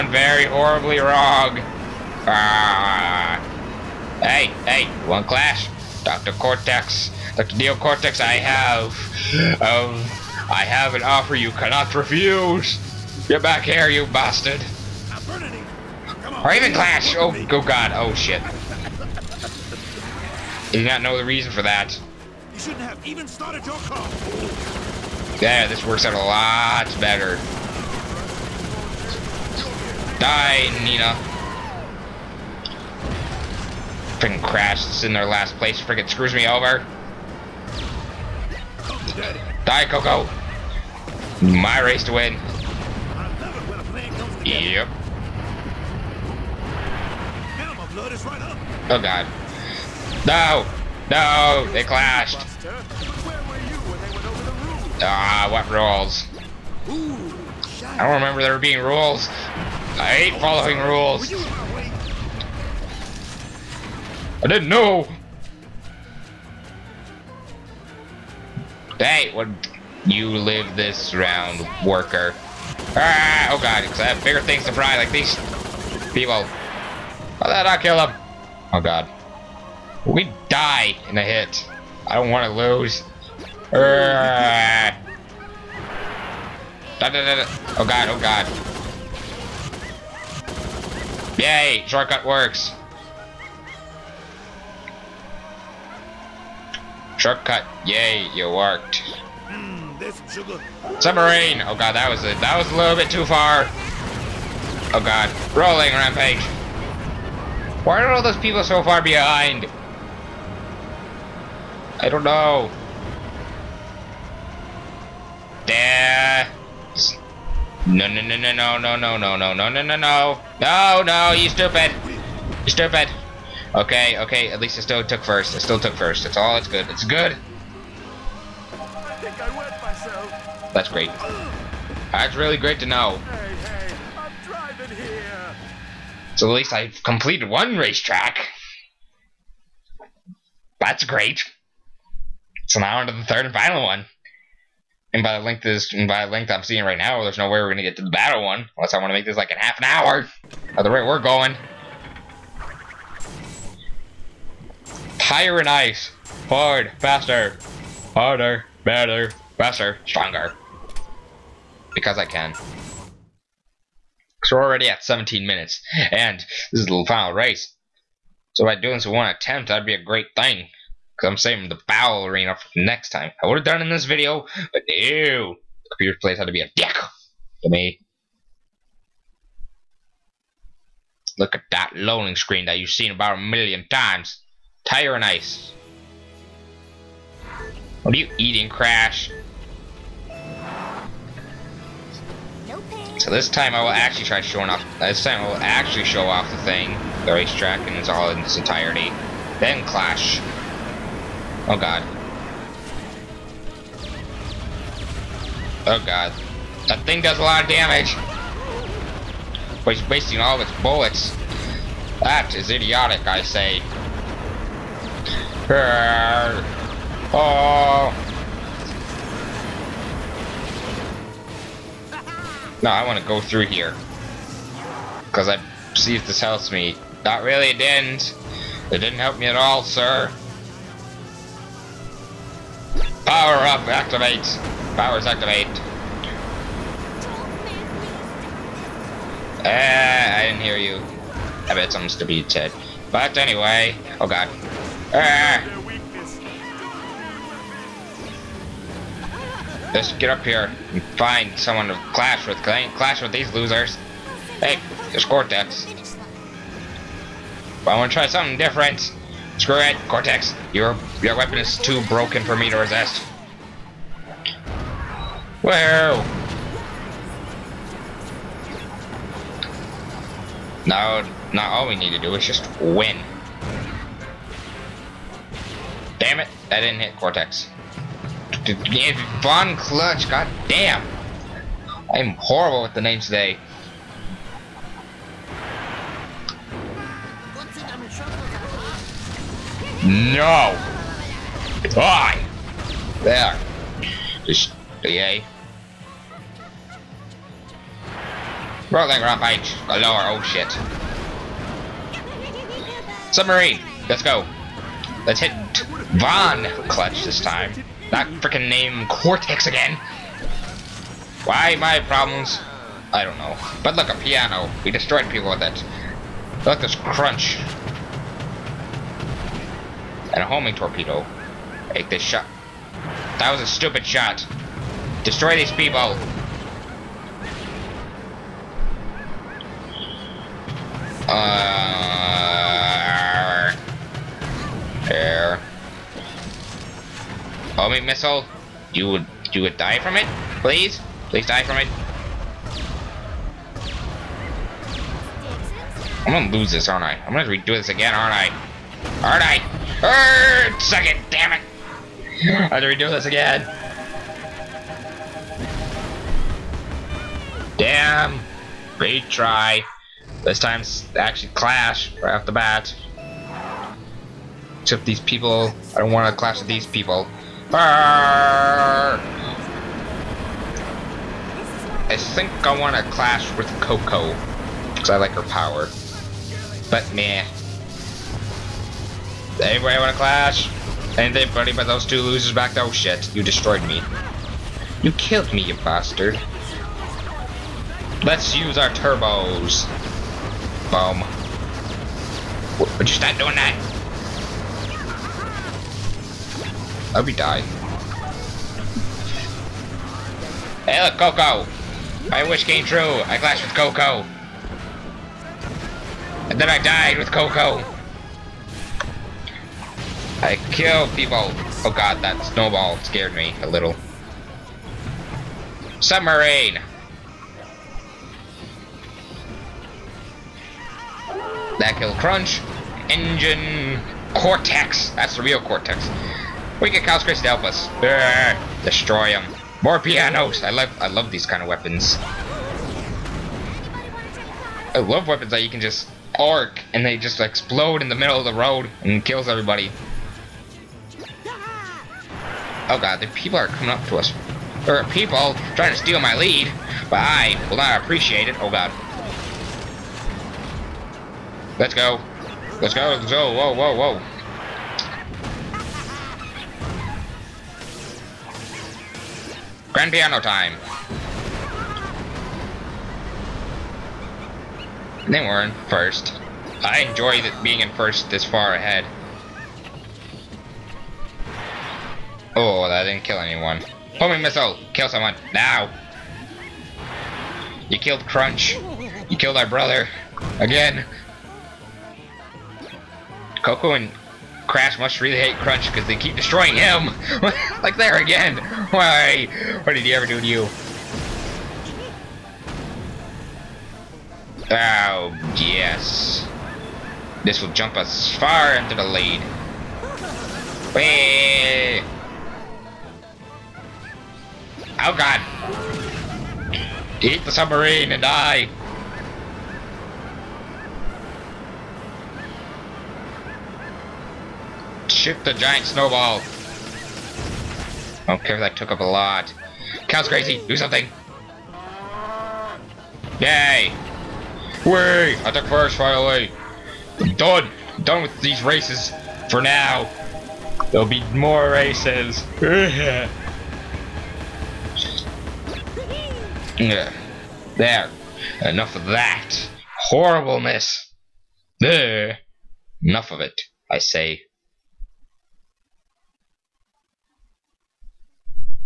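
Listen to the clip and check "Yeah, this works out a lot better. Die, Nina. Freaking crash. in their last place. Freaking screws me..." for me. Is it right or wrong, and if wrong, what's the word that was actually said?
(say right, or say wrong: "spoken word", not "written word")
right.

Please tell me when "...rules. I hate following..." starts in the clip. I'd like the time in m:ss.
0:58.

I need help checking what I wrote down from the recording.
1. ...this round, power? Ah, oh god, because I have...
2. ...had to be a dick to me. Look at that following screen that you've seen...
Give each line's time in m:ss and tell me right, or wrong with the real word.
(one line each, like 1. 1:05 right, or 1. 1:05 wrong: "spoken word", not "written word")
1. 1:10 wrong: "worker", not "power"
2. 2:56 wrong: "loading", not "following".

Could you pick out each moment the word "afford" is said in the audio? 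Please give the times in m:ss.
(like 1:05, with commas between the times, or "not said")
not said.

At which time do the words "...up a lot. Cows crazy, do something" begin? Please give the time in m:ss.
8:38.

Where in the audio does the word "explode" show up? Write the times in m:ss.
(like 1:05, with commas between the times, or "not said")
7:17.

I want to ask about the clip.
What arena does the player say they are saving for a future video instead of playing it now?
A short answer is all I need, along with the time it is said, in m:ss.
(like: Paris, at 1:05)
foul arena, at 2:51.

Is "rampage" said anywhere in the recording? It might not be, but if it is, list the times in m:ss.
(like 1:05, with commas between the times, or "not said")
1:45, 4:59.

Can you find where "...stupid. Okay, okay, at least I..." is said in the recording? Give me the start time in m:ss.
2:02.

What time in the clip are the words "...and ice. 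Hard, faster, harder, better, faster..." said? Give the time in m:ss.
2:35.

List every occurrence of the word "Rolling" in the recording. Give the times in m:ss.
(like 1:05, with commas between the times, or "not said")
1:45, 4:58.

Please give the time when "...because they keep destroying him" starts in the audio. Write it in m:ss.
8:05.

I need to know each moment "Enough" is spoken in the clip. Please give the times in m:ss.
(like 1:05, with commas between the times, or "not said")
8:58, 9:03.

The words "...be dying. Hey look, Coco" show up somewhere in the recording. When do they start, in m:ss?
6:37.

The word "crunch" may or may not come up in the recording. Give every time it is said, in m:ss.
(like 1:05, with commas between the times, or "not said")
5:16, 7:02, 7:58, 8:05.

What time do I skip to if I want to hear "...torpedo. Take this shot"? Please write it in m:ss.
5:20.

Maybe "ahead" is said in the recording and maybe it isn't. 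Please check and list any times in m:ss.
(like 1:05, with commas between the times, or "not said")
7:48.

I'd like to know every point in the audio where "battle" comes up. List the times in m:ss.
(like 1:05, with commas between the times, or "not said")
2:28.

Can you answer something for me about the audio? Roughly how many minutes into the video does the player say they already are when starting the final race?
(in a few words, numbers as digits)
17.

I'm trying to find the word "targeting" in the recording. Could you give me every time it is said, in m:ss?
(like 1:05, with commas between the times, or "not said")
not said.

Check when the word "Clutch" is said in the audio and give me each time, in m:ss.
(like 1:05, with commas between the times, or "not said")
4:39, 5:06.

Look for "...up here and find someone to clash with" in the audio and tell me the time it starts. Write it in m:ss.
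4:10.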